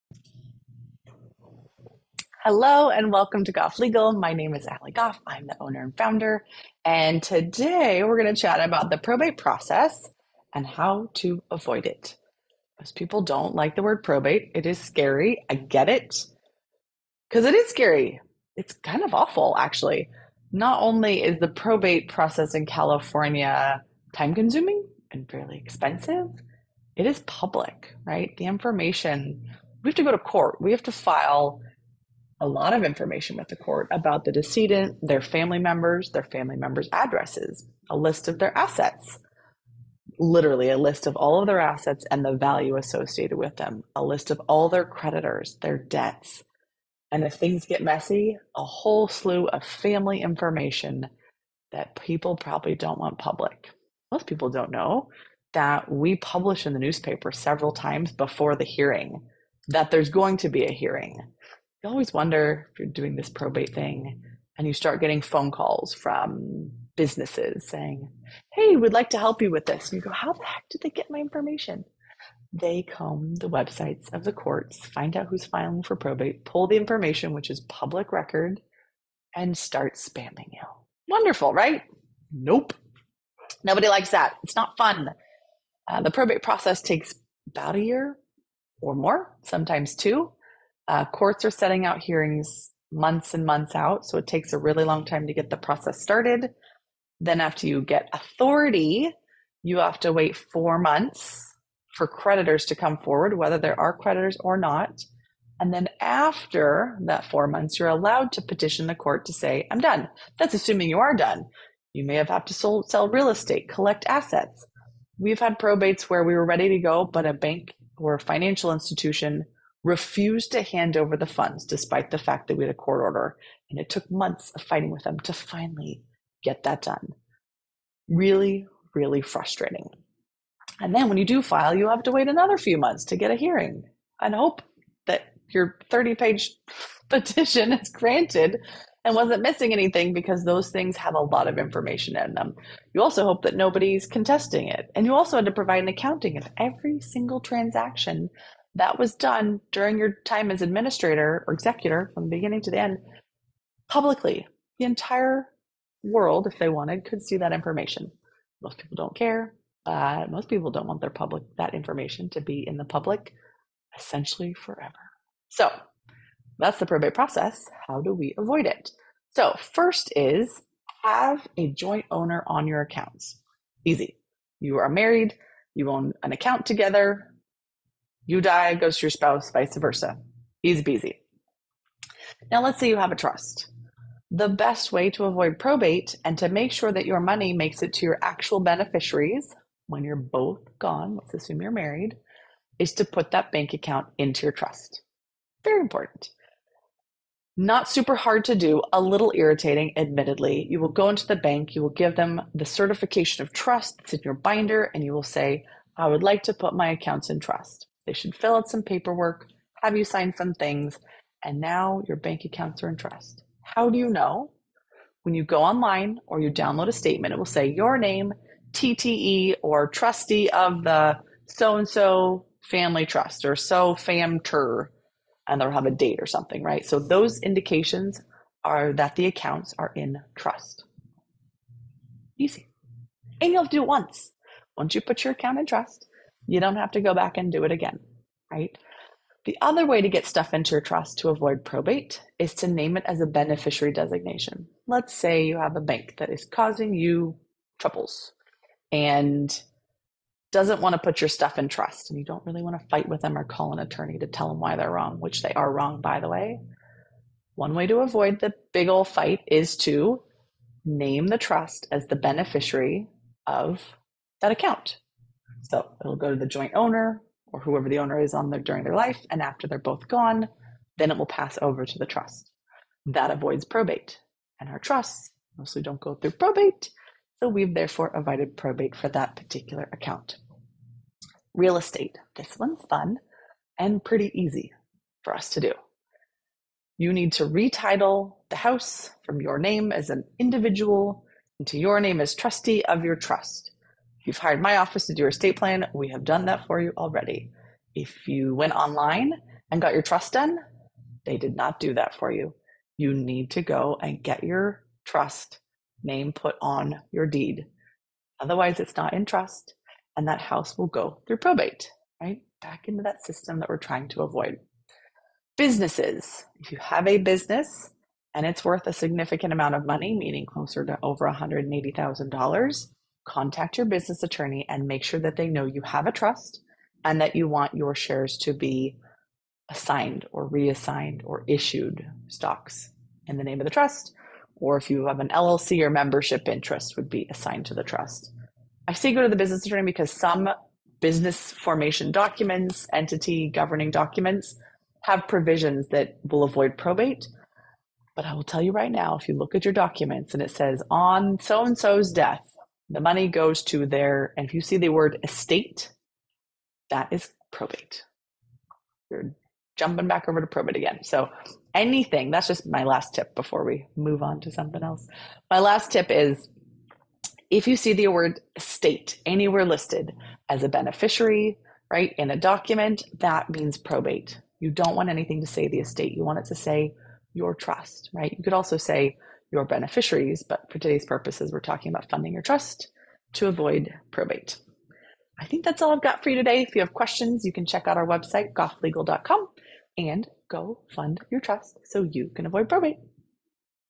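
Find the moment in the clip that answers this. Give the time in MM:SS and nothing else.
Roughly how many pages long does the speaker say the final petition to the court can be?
02:15.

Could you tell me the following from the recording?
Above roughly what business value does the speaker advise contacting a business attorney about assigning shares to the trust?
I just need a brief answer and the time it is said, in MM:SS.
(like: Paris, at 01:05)
$180,000, at 05:21.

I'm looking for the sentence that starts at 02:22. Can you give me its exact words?
You also hope that nobody's contesting it.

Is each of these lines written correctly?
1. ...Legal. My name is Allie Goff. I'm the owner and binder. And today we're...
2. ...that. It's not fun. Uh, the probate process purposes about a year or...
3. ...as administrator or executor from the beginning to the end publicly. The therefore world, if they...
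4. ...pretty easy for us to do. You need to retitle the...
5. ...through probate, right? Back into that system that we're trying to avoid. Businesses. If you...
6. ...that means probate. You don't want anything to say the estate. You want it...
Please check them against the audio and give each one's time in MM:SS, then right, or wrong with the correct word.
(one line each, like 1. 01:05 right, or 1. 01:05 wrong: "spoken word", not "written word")
1. 00:03 wrong: "founder", not "binder"
2. 01:24 wrong: "takes", not "purposes"
3. 02:30 wrong: "entire", not "therefore"
4. 04:44 right
5. 05:11 right
6. 06:13 right.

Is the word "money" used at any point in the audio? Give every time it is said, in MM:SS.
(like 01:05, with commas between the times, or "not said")
03:07, 05:19, 05:52.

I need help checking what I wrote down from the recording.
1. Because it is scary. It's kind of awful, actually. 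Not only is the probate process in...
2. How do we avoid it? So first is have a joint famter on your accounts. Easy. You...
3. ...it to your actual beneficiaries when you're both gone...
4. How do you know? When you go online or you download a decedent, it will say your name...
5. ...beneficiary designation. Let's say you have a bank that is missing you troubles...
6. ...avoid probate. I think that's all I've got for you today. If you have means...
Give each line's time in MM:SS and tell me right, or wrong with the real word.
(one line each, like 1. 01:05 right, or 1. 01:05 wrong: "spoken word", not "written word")
1. 00:17 right
2. 02:47 wrong: "owner", not "famter"
3. 03:07 right
4. 03:33 wrong: "statement", not "decedent"
5. 04:03 wrong: "causing", not "missing"
6. 06:23 wrong: "questions", not "means".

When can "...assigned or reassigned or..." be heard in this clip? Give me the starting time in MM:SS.
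05:29.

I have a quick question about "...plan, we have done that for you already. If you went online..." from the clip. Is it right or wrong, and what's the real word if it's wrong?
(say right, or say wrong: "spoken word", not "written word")
right.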